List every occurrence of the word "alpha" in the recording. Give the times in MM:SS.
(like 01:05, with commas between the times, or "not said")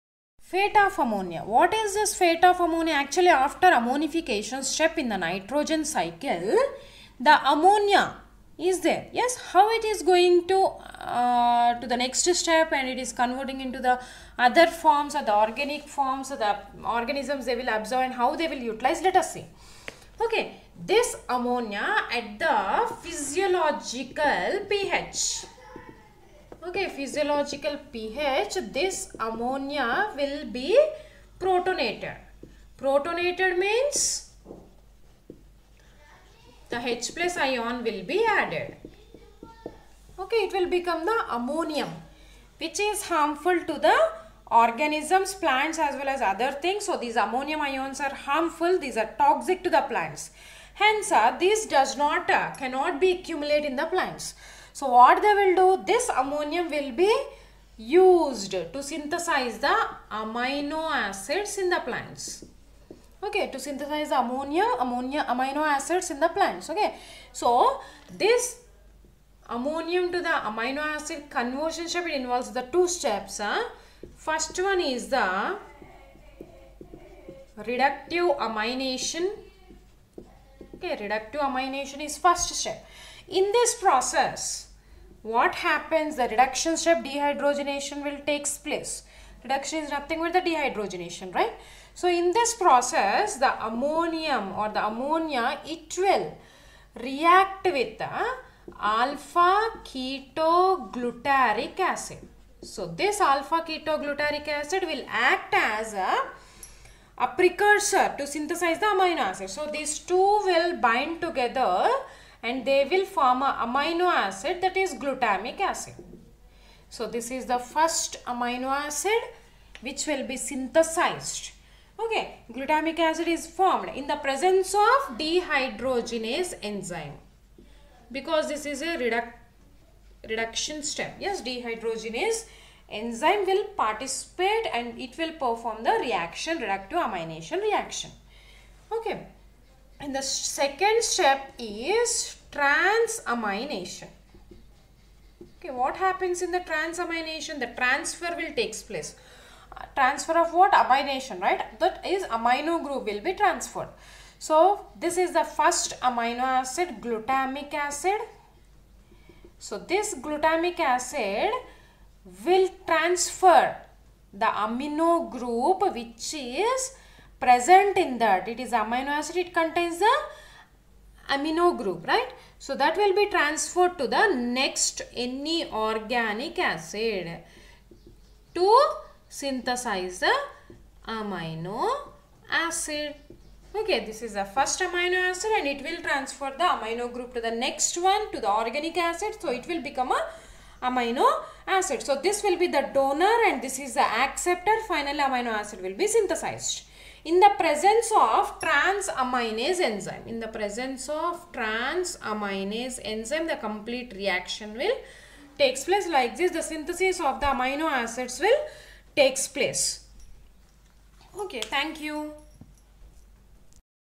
01:38, 01:43.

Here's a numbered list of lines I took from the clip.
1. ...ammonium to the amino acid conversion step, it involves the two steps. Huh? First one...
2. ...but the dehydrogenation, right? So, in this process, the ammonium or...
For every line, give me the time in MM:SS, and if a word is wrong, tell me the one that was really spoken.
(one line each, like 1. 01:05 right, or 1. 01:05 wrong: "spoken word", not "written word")
1. 01:09 right
2. 01:30 right.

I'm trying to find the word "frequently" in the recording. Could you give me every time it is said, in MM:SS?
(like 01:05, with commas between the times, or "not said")
not said.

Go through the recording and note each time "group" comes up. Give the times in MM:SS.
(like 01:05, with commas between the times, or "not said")
02:32, 02:45, 02:51, 03:07.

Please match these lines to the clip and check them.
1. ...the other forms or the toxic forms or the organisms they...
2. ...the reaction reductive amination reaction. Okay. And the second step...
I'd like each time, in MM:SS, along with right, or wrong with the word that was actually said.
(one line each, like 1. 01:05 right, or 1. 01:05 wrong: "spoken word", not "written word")
1. 00:13 wrong: "organic", not "toxic"
2. 02:15 right.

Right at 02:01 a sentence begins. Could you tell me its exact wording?
Okay, glutamic acid is formed in the presence of dehydrogenase enzyme because this is a reduc reduction step.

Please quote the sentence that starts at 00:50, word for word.
Hence uh, this does not, uh, cannot be accumulated in the plants.